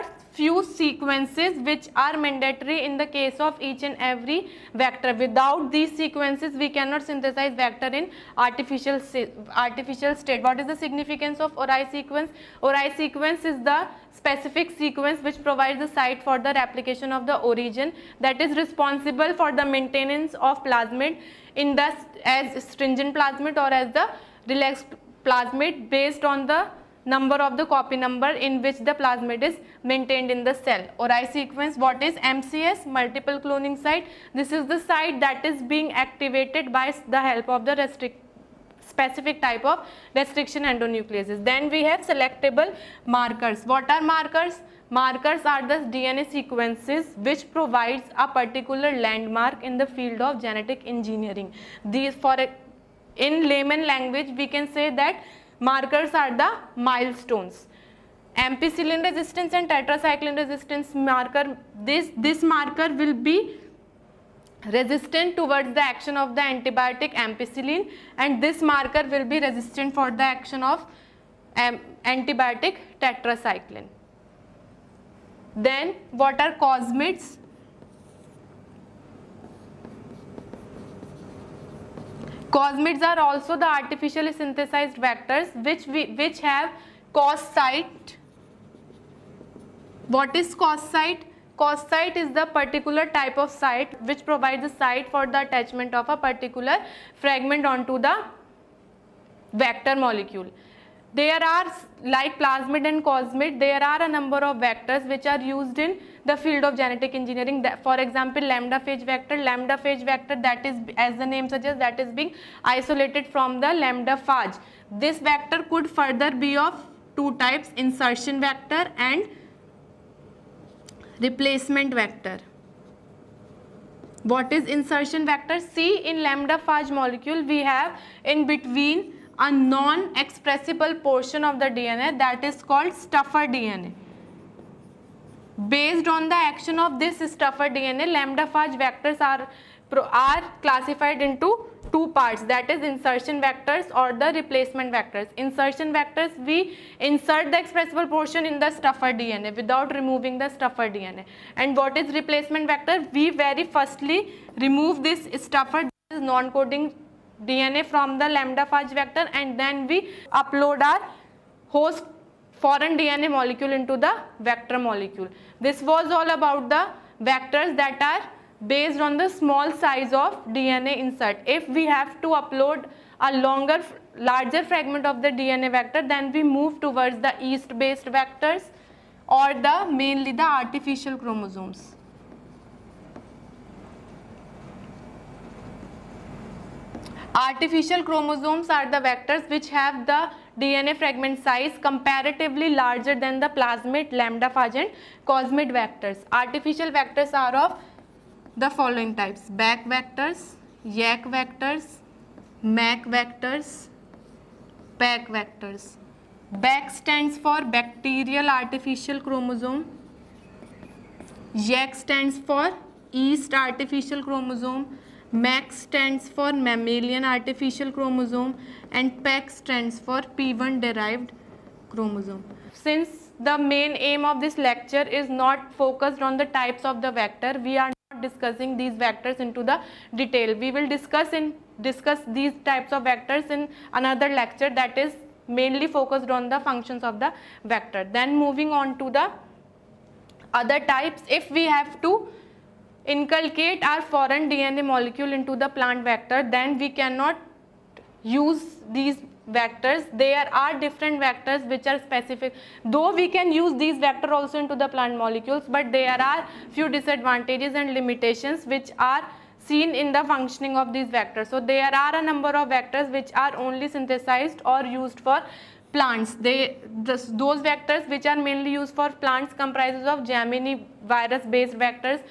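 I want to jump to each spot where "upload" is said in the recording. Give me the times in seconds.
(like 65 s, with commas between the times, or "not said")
160 s, 172 s.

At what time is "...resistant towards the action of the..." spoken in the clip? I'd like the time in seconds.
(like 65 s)
64 s.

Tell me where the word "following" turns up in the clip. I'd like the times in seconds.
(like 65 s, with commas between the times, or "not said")
198 s.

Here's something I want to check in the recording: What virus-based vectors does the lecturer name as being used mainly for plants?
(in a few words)
Gemini virus based vectors.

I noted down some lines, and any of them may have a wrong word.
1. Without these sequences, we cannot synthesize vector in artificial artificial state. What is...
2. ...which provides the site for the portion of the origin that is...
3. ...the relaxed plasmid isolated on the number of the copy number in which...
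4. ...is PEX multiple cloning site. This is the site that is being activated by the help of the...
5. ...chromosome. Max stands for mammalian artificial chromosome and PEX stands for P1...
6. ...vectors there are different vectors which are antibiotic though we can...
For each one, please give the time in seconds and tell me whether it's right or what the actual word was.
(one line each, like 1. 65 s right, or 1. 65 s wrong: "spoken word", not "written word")
1. 5 s right
2. 15 s wrong: "replication", not "portion"
3. 23 s wrong: "based", not "isolated"
4. 32 s wrong: "MCS", not "PEX"
5. 214 s right
6. 249 s wrong: "specific", not "antibiotic".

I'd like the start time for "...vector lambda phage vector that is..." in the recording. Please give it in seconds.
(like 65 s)
109 s.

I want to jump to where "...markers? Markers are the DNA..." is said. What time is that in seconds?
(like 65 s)
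44 s.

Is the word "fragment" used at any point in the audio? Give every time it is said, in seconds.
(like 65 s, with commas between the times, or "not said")
97 s, 174 s, 190 s.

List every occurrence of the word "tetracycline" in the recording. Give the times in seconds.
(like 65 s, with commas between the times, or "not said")
59 s, 72 s.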